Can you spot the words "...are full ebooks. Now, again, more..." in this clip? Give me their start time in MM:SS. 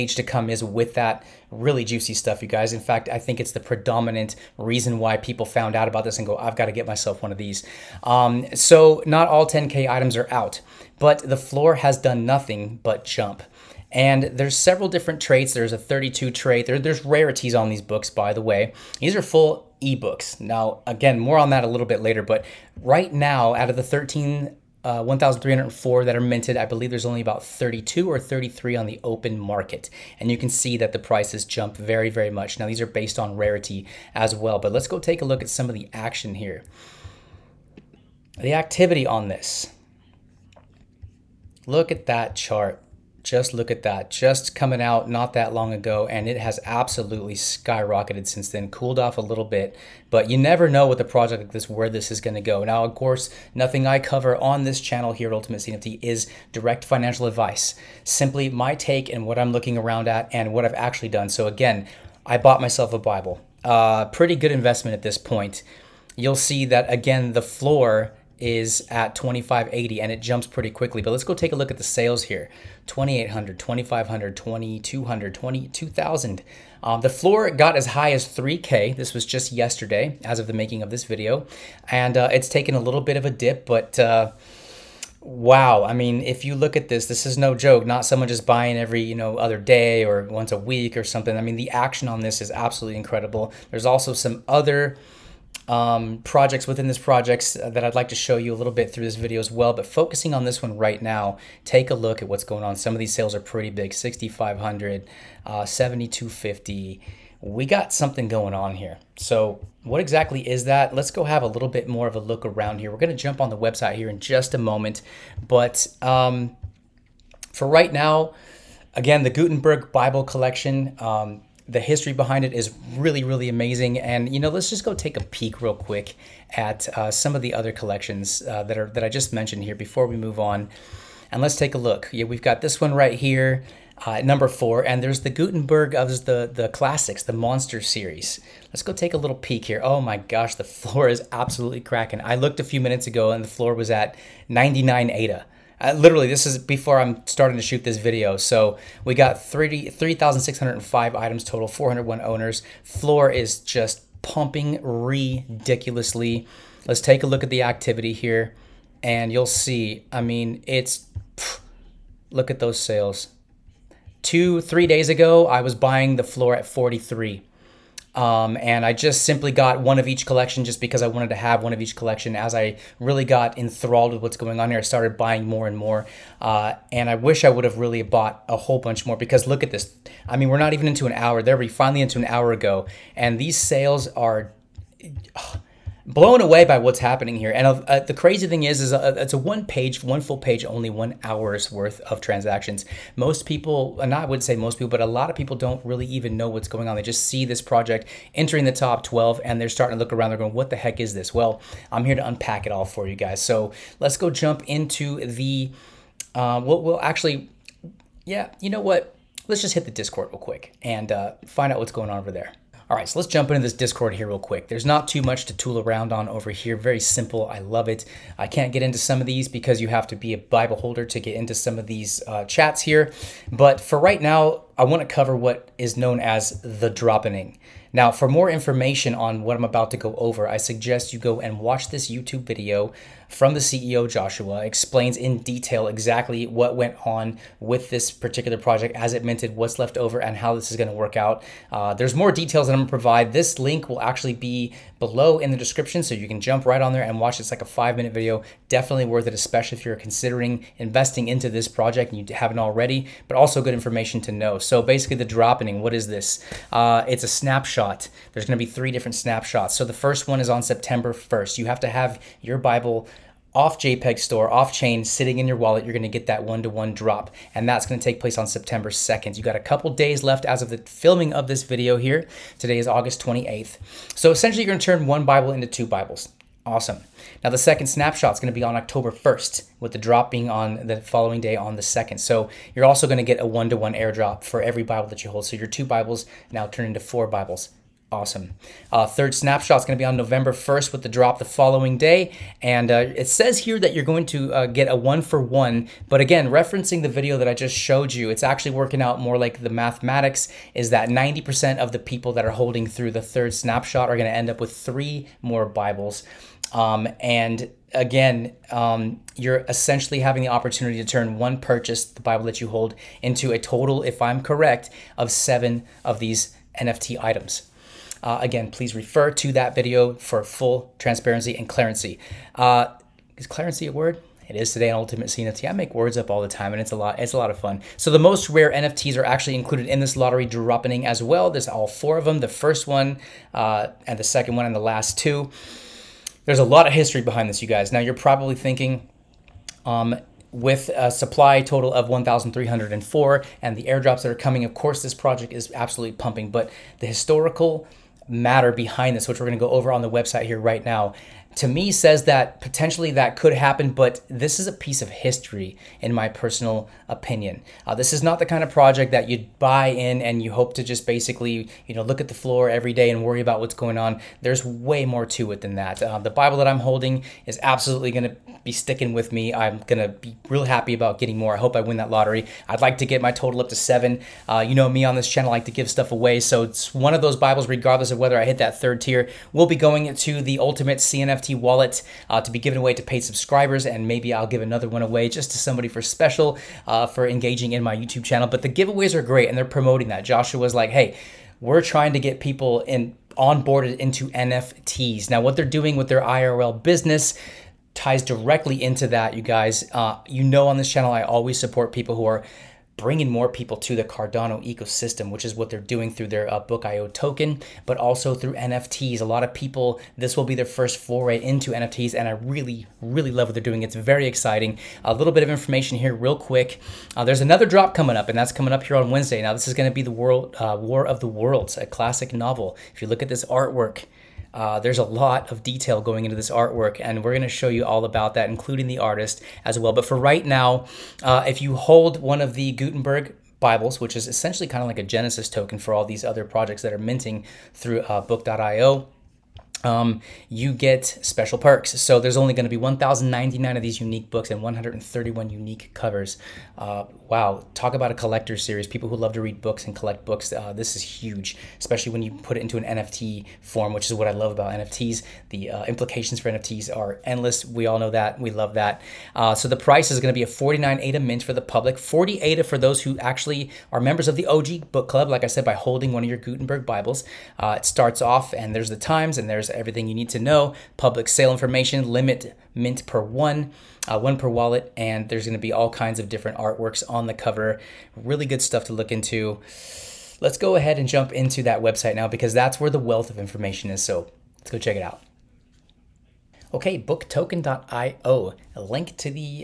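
00:19.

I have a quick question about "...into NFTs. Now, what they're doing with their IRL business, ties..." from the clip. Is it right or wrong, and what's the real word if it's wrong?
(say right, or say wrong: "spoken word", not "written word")
right.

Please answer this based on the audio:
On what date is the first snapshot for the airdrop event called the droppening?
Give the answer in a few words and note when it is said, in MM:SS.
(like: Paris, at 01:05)
September 1st, at 04:20.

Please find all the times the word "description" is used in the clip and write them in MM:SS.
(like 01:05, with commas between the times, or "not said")
04:05.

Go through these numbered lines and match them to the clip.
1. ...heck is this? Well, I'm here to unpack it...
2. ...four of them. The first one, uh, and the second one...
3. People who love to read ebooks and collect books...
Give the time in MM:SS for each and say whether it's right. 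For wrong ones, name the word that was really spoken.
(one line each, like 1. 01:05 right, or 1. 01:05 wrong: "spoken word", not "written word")
1. 03:20 right
2. 05:31 right
3. 07:28 wrong: "books", not "ebooks".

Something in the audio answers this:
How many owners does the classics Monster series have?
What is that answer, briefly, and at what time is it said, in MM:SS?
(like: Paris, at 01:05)
401, at 02:31.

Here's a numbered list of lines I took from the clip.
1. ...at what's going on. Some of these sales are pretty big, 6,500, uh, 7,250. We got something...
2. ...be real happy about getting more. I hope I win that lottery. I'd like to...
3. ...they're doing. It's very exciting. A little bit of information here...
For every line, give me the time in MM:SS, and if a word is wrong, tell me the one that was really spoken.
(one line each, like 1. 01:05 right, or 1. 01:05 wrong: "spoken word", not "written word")
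1. 01:42 right
2. 06:10 right
3. 06:53 right.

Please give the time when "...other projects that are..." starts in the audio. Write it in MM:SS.
07:16.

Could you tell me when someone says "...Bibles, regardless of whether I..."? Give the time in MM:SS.
06:17.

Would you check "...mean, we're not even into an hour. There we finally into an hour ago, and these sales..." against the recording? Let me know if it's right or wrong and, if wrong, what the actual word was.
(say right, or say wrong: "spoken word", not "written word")
right.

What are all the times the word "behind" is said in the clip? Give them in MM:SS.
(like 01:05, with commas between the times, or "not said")
02:02, 05:37, 05:48.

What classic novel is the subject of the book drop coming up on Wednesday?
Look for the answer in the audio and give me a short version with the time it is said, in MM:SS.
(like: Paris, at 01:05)
War of the Worlds, at 07:00.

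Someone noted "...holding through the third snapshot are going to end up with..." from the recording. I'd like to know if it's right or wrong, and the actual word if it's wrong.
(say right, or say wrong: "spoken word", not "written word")
right.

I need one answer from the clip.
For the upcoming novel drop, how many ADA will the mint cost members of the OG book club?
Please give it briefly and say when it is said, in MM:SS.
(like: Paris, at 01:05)
40 ADA, at 07:41.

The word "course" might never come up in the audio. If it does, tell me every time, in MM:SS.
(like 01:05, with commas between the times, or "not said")
00:52, 05:44.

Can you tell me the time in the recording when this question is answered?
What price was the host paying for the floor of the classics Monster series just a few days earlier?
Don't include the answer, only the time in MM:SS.
02:46.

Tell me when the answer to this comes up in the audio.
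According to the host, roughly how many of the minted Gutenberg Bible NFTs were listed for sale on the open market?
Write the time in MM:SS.
00:27.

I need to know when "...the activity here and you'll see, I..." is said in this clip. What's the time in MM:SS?
02:37.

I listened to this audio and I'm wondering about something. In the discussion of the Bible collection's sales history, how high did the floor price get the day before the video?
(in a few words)
3K.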